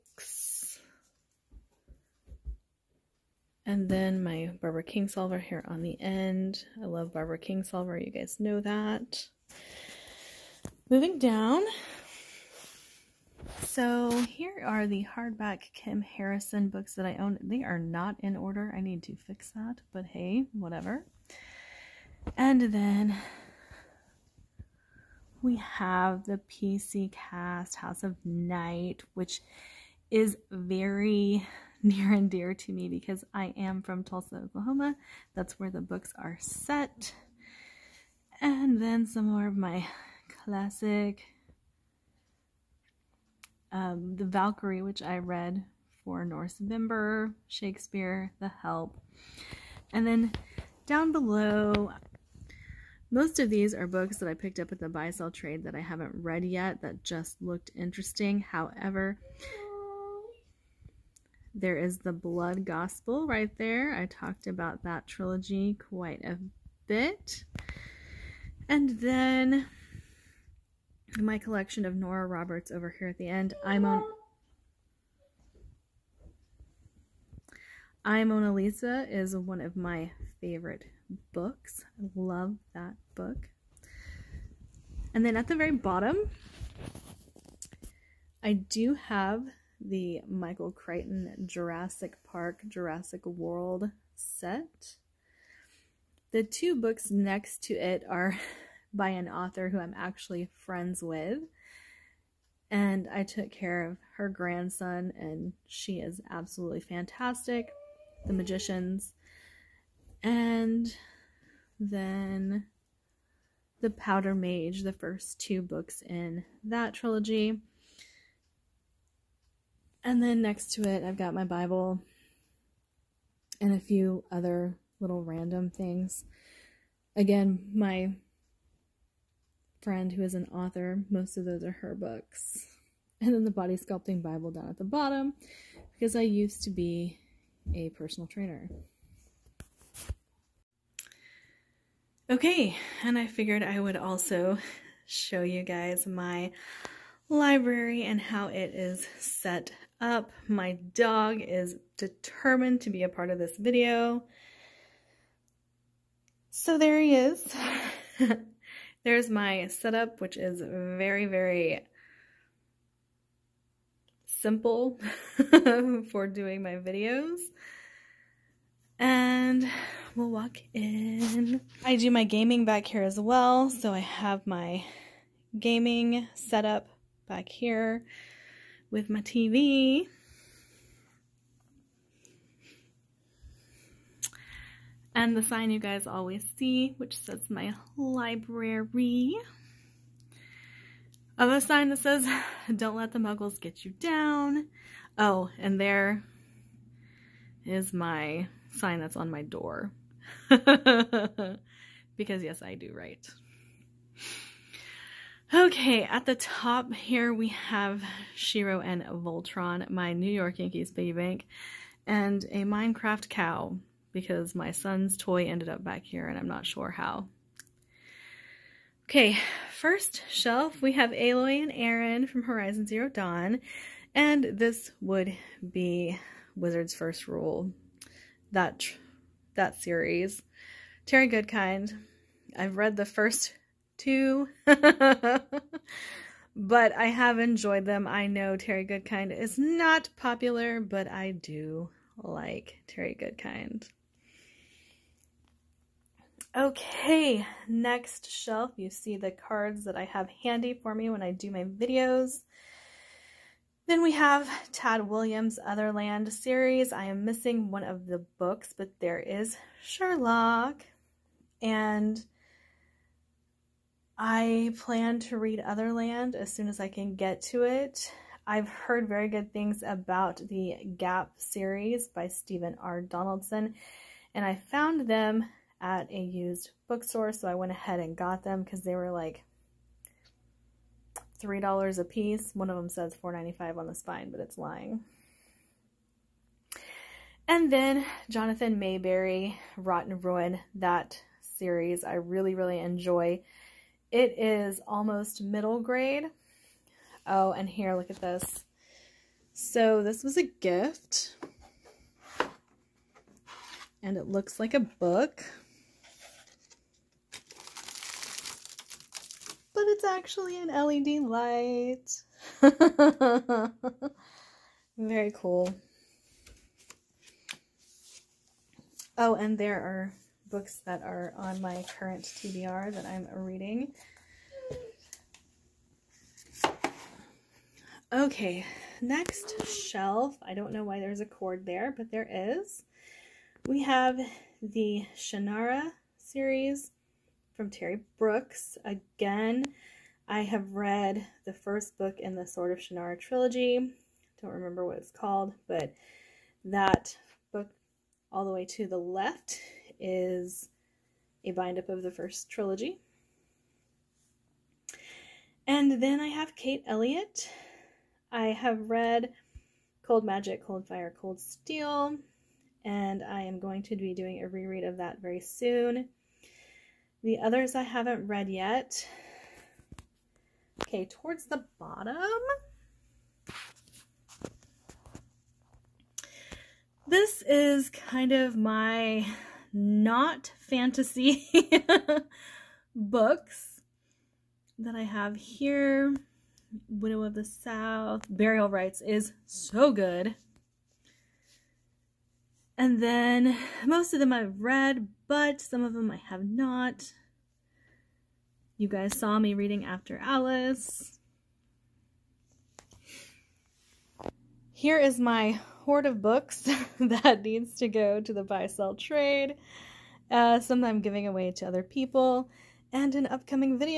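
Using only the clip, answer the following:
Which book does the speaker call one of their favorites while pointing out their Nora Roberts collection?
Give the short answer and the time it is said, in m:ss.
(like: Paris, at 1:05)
I Mona Lisa, at 1:18.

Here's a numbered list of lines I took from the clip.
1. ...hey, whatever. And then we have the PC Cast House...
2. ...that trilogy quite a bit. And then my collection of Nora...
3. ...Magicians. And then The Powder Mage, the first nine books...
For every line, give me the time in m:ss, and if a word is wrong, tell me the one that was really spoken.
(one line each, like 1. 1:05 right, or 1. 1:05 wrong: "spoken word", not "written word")
1. 0:20 right
2. 1:04 right
3. 1:48 wrong: "two", not "nine".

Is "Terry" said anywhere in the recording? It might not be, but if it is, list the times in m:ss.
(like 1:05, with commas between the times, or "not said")
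3:51, 3:58, 4:02, 5:37.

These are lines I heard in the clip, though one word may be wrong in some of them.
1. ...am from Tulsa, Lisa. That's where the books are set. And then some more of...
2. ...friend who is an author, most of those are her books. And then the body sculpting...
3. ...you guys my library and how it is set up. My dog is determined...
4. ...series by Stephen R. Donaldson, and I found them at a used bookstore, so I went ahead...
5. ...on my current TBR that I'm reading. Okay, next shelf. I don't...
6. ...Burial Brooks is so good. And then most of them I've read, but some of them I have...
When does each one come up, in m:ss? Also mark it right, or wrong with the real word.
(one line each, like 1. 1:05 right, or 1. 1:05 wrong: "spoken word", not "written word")
1. 0:33 wrong: "Oklahoma", not "Lisa"
2. 2:09 right
3. 2:25 right
4. 4:31 right
5. 5:21 right
6. 6:28 wrong: "Rites", not "Brooks".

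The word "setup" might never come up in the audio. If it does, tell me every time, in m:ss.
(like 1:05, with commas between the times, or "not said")
2:39, 2:56.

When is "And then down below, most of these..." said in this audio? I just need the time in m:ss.
0:49.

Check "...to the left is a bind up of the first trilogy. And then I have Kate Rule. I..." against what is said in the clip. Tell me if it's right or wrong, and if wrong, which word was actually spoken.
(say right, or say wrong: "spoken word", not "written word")
wrong: "Elliott", not "Rule".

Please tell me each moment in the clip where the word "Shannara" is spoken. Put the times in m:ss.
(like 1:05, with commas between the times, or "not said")
5:35, 5:42.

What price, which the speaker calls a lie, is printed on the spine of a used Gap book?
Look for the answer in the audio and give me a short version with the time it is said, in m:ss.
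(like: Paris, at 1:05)
$4.95, at 4:43.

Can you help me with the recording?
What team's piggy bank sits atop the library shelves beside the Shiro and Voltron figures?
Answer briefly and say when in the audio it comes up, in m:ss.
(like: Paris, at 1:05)
New York Yankees, at 3:30.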